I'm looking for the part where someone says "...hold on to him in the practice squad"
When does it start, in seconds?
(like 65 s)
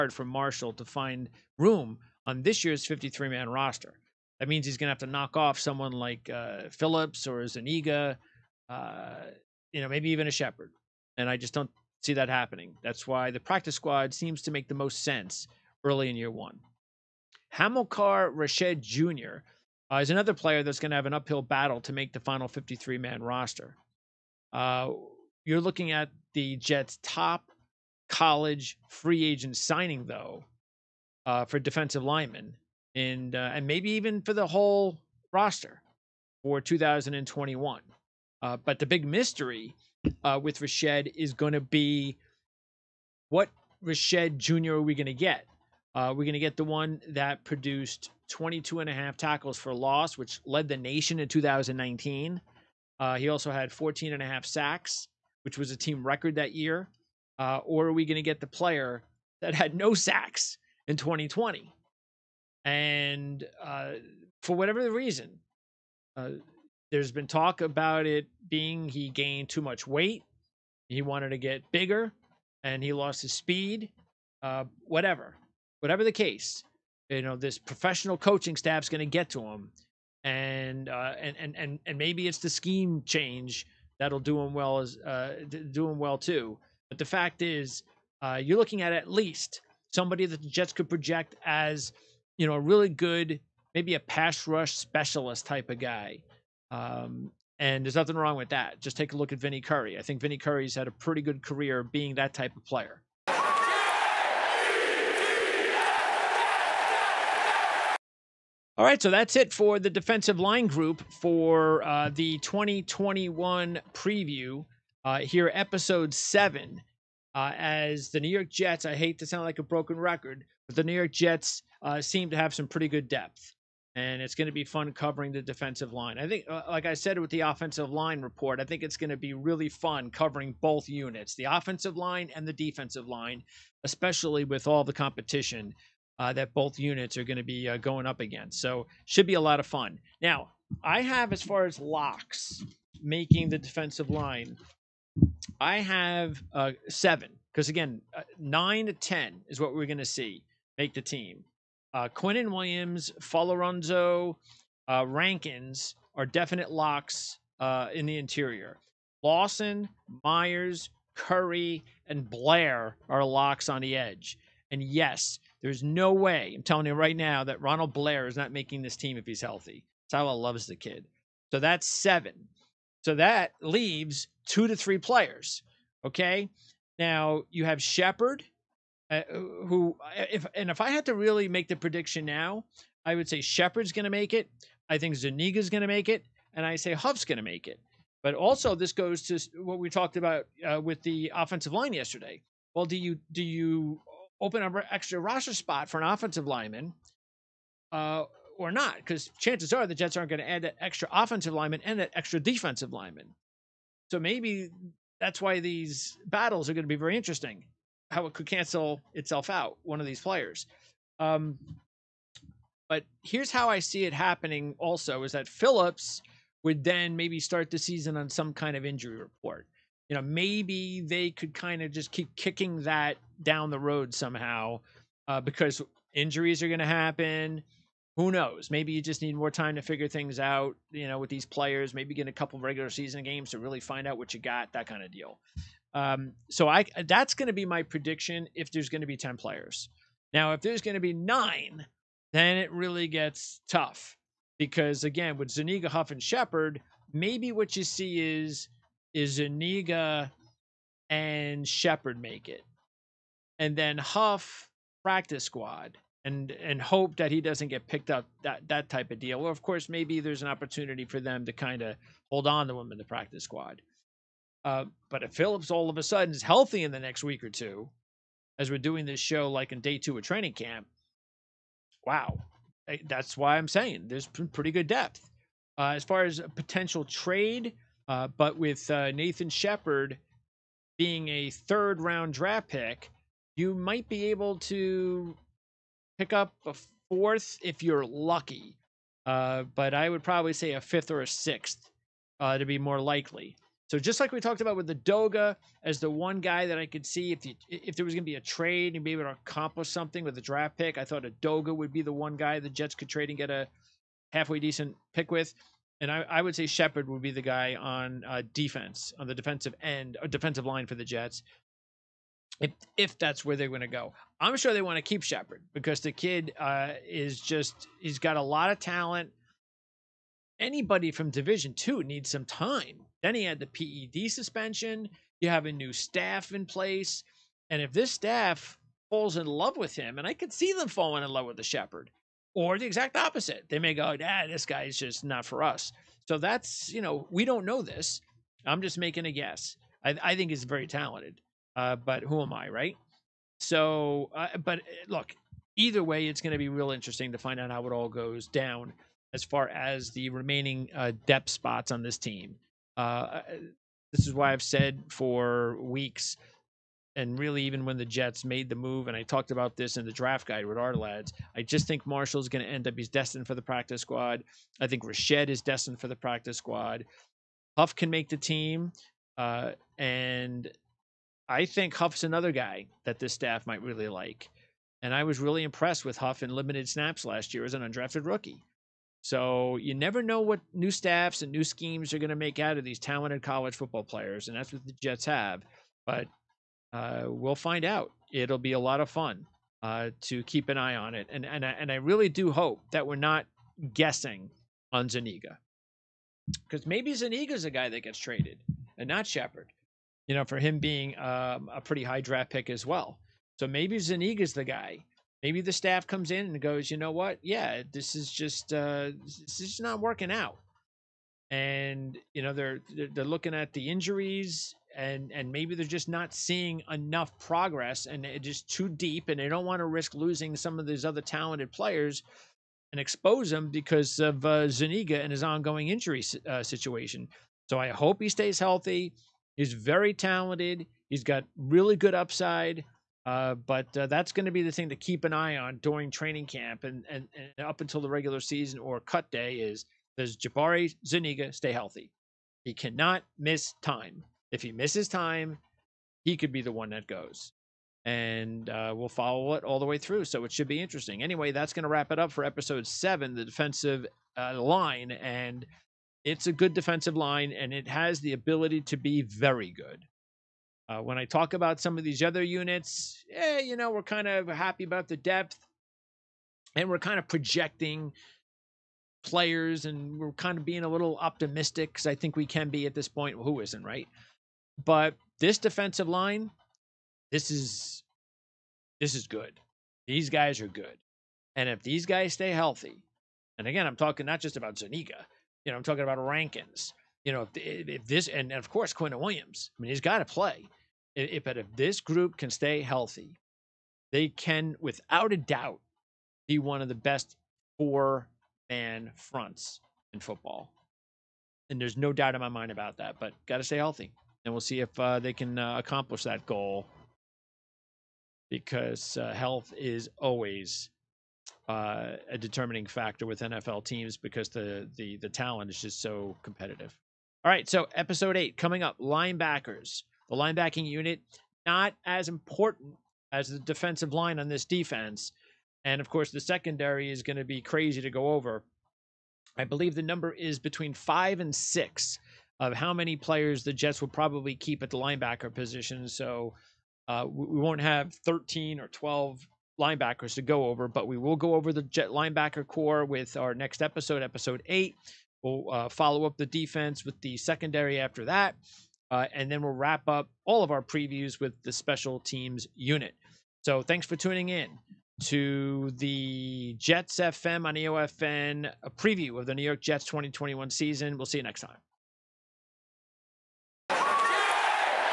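262 s.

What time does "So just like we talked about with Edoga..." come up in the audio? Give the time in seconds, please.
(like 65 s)
293 s.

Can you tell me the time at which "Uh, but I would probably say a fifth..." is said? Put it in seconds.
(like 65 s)
289 s.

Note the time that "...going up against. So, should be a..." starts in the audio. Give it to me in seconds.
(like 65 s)
137 s.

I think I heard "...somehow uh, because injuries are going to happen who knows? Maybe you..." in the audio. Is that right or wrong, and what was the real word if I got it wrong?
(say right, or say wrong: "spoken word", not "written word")
right.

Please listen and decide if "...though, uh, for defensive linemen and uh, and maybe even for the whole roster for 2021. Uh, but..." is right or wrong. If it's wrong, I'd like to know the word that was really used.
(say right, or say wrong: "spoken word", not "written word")
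right.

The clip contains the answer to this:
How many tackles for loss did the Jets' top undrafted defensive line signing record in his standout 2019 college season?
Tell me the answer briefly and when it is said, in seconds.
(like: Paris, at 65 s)
22.5, at 48 s.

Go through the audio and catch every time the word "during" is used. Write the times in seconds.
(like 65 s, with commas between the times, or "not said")
435 s.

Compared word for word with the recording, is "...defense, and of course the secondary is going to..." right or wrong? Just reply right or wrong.
right.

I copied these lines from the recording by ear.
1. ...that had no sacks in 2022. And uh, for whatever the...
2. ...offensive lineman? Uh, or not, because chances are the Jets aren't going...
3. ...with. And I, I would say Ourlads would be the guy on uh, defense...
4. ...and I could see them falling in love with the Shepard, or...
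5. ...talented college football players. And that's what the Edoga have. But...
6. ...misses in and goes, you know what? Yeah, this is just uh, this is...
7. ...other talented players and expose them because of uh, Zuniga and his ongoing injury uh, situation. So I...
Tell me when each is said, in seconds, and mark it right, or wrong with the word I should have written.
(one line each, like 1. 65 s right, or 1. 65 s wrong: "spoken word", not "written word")
1. 59 s wrong: "2020", not "2022"
2. 196 s right
3. 305 s wrong: "Shepard", not "Ourlads"
4. 330 s right
5. 382 s wrong: "Jets", not "Edoga"
6. 406 s wrong: "comes", not "misses"
7. 421 s right.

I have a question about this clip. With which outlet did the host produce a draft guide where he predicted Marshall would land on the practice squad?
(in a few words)
Ourlads.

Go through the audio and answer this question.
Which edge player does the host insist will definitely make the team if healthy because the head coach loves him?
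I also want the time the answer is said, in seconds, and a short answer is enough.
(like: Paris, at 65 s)
Ronald Blair, at 167 s.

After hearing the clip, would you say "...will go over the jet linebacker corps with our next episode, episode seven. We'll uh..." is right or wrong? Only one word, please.
wrong.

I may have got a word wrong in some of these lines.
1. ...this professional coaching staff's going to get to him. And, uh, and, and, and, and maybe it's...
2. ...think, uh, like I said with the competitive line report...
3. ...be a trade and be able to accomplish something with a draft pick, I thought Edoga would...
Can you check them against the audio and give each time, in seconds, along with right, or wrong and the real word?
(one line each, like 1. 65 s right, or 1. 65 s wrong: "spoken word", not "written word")
1. 77 s right
2. 126 s wrong: "offensive", not "competitive"
3. 298 s right.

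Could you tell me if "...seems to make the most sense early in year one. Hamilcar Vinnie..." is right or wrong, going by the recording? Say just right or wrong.
wrong.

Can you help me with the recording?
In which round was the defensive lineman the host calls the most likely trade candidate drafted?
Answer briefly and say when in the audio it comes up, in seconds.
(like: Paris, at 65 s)
Third round, at 281 s.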